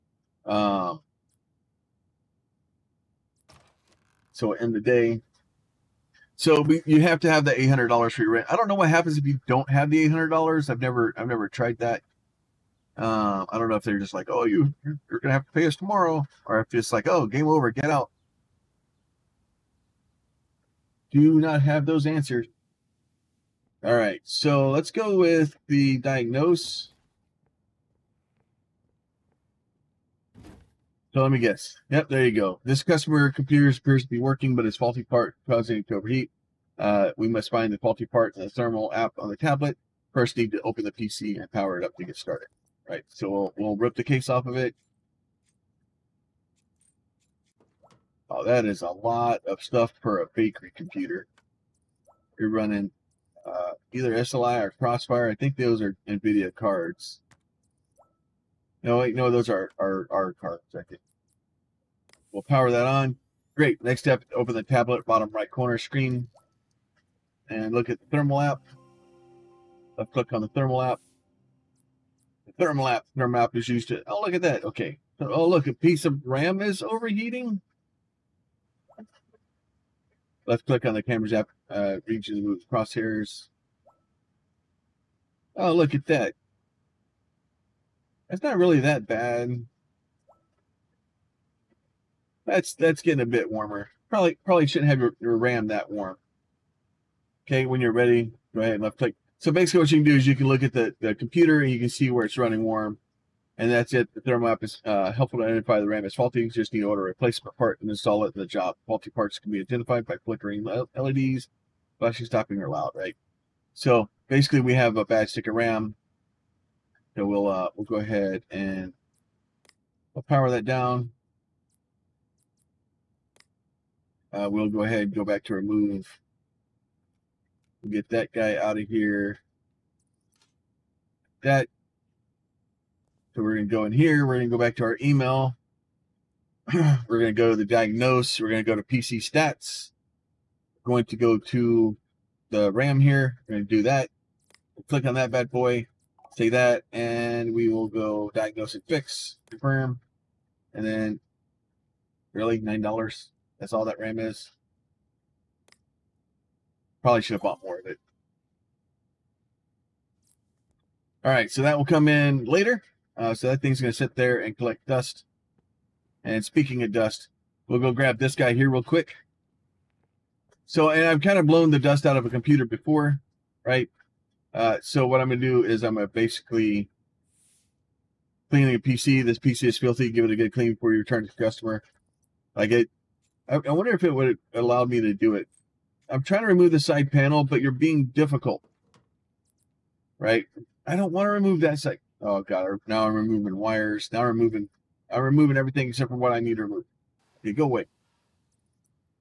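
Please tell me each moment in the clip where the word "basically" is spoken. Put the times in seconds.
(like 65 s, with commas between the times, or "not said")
99 s, 114 s, 176 s.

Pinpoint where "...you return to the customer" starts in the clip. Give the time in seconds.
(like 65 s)
180 s.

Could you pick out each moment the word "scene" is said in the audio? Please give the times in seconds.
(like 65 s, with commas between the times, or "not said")
not said.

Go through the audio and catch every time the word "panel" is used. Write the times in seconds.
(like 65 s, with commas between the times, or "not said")
187 s.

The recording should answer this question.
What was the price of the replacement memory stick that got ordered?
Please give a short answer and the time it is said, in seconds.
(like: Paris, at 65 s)
$9, at 152 s.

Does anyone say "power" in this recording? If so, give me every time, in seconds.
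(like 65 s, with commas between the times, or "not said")
41 s, 62 s, 120 s.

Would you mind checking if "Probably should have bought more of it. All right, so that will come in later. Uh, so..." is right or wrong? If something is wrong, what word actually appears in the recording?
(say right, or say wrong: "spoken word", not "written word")
right.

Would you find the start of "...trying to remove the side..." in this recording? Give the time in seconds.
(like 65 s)
186 s.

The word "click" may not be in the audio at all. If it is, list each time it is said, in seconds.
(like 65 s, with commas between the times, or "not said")
70 s, 80 s, 98 s, 144 s.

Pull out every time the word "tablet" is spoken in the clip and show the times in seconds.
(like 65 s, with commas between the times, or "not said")
39 s, 64 s.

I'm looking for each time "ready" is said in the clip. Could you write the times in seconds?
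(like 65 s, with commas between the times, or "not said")
97 s.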